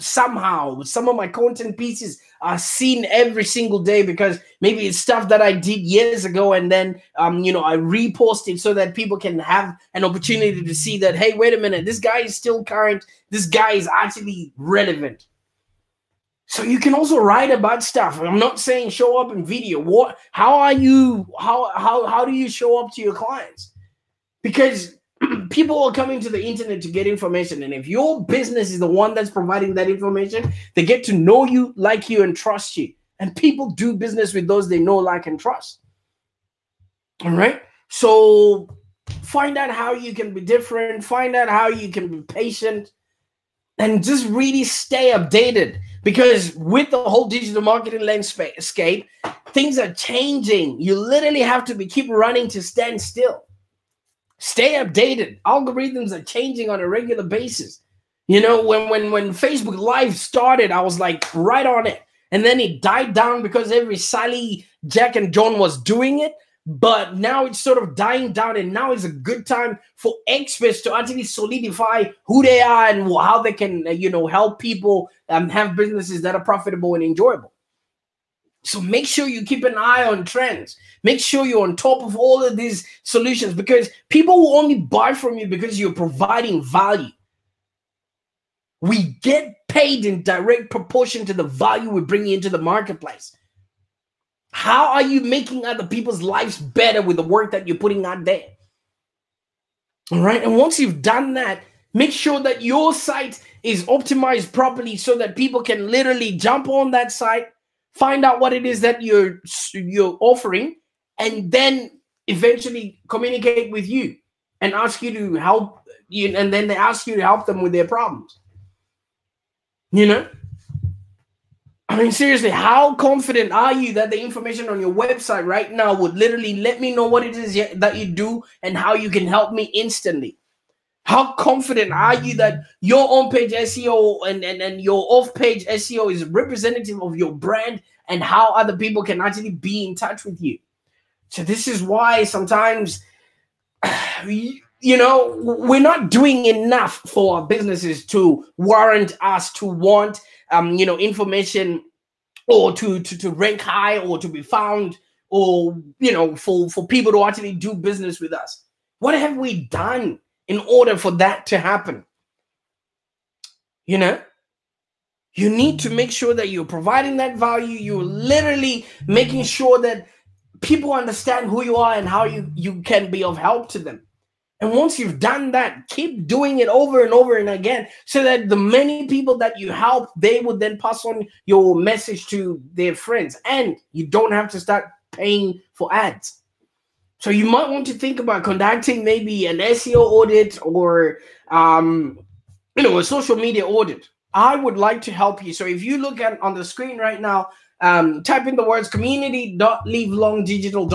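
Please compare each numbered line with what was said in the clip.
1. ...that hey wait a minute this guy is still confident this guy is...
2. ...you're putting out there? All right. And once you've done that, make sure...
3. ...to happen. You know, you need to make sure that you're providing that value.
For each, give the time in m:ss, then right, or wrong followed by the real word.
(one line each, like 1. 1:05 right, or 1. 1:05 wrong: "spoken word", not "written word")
1. 0:10 wrong: "current", not "confident"
2. 1:37 right
3. 2:41 right.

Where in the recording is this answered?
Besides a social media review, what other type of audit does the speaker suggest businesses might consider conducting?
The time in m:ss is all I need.
3:09.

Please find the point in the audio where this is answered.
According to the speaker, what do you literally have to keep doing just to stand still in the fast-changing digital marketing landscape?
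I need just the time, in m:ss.
0:51.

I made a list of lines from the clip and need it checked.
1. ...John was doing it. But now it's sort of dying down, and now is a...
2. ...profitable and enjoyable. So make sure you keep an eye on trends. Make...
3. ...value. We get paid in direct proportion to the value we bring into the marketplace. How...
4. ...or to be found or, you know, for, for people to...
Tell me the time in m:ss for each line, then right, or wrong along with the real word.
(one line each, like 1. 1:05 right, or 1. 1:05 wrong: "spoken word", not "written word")
1. 1:05 right
2. 1:16 right
3. 1:26 right
4. 2:33 right.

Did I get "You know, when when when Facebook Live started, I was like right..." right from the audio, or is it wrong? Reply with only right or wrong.
right.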